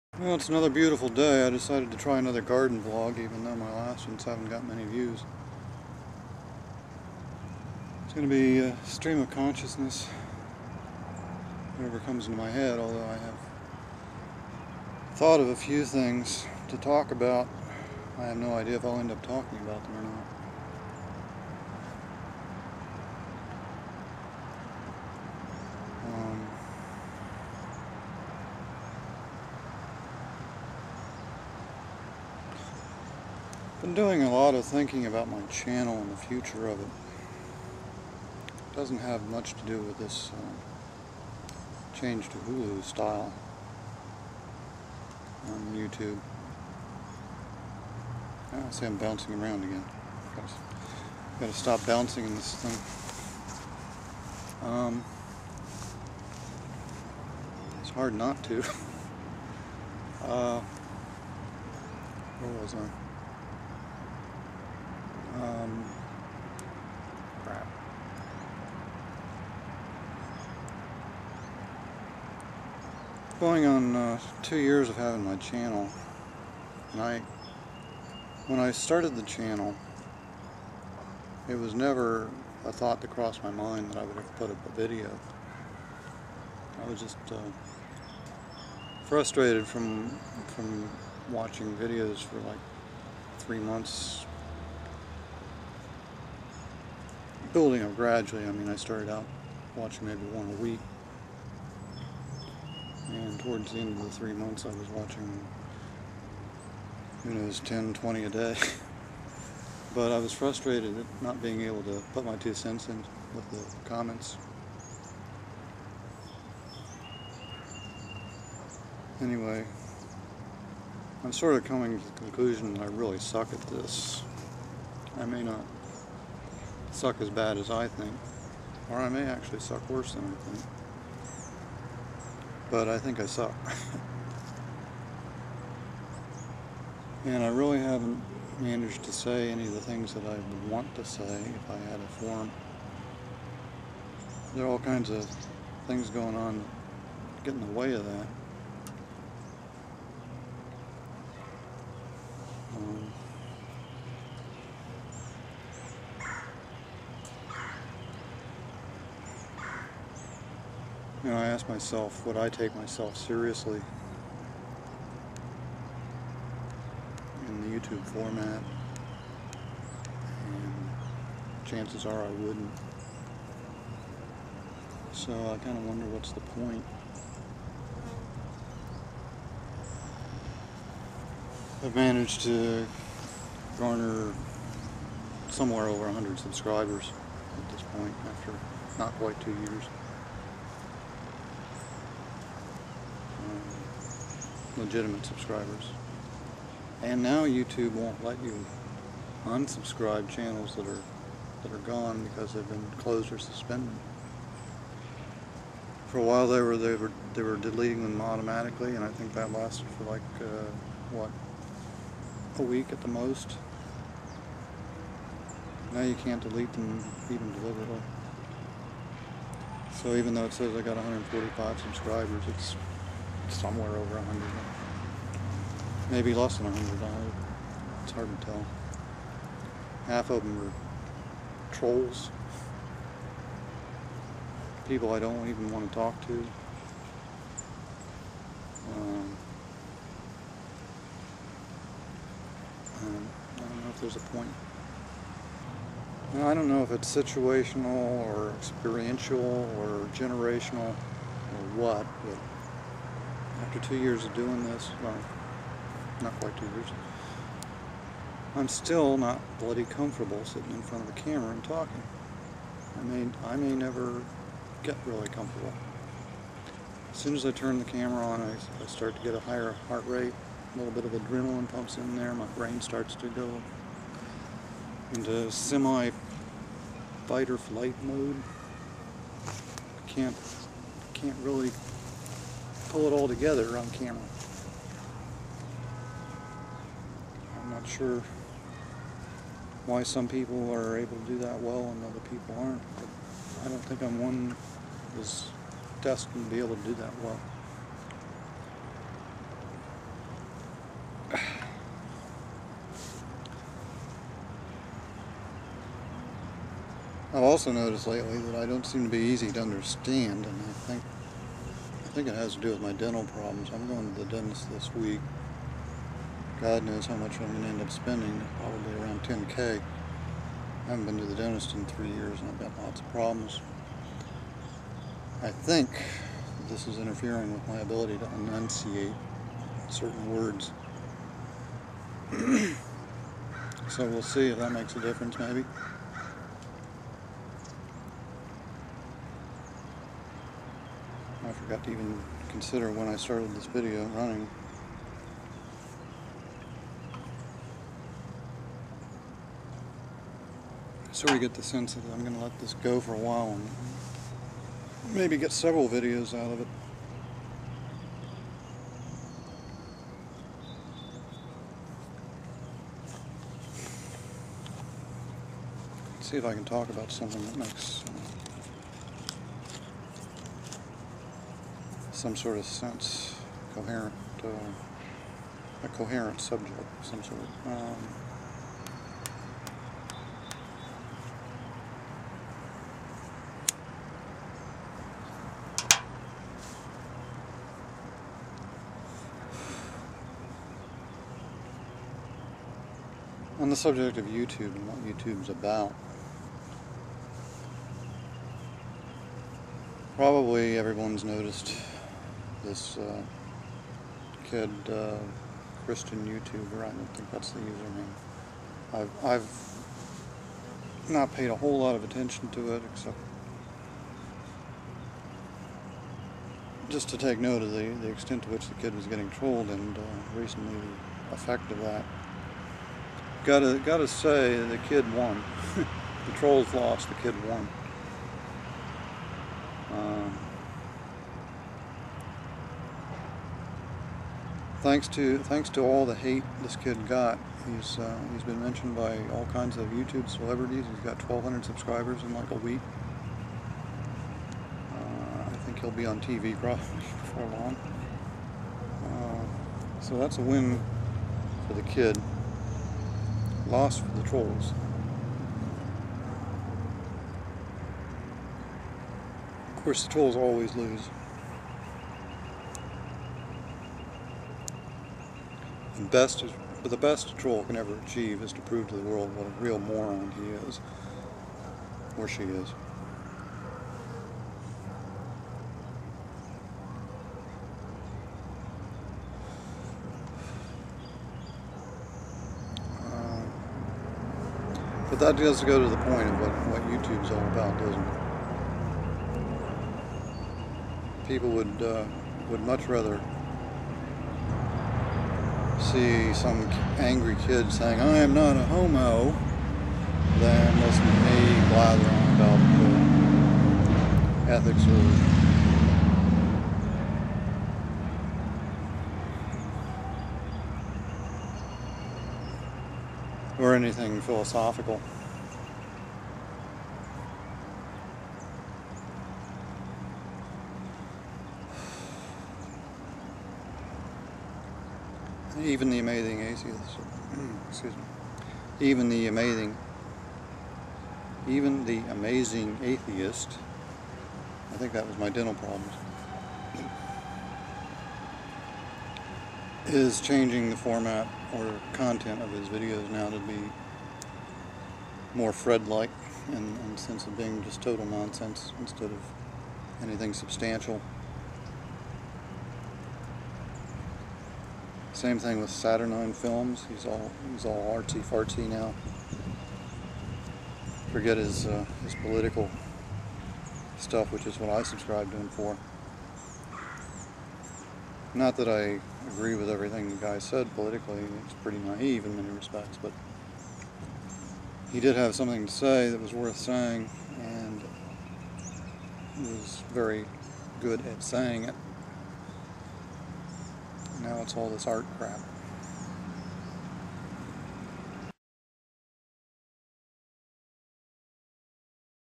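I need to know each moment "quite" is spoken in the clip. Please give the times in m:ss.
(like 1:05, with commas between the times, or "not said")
3:09, 4:16.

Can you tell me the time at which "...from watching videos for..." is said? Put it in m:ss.
1:30.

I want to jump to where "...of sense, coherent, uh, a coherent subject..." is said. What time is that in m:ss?
6:12.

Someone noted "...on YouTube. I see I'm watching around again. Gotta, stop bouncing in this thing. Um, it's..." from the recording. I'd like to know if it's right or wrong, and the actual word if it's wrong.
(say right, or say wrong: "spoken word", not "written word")
wrong: "bouncing", not "watching".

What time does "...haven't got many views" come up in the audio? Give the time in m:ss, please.
0:04.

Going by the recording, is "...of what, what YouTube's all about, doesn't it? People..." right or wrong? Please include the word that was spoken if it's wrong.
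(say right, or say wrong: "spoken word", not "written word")
right.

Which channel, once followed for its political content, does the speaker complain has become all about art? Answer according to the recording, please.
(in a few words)
Saturnine Films.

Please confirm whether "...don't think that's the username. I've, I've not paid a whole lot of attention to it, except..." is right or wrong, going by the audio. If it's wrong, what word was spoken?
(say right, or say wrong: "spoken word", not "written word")
right.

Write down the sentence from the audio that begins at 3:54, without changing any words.
People I don't even want to talk to.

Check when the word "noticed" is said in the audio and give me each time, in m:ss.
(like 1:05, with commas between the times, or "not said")
5:07, 6:41.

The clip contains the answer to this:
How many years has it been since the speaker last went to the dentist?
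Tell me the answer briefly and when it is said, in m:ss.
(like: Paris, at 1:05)
3 years, at 5:21.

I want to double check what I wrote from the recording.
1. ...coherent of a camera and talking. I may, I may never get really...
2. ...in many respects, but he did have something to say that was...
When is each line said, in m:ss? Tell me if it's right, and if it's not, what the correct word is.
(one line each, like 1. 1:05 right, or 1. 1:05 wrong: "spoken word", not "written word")
1. 4:20 wrong: "front", not "coherent"
2. 9:32 right.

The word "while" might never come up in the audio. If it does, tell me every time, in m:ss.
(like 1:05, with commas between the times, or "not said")
3:26, 5:53.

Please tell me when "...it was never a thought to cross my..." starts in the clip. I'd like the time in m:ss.
1:21.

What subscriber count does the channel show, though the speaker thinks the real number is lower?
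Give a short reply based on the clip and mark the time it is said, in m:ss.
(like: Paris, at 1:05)
145, at 3:40.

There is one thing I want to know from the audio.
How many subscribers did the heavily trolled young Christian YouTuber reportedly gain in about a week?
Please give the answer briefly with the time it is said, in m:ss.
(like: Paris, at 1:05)
1,200, at 7:21.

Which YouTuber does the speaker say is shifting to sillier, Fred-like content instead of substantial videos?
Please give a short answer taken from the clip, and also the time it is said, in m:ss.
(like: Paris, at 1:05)
The Amazing Atheist, at 8:52.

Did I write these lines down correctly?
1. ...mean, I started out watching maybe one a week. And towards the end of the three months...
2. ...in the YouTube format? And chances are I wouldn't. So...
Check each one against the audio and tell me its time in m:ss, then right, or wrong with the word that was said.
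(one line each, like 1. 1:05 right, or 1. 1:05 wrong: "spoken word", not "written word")
1. 1:38 right
2. 2:47 right.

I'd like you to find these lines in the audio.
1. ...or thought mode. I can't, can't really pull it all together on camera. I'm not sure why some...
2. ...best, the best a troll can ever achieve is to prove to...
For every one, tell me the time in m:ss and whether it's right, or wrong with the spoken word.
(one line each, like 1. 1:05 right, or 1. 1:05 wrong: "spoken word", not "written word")
1. 4:37 wrong: "flight", not "thought"
2. 7:46 right.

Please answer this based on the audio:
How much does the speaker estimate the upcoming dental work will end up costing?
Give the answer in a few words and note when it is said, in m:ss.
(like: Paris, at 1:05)
10k, at 5:19.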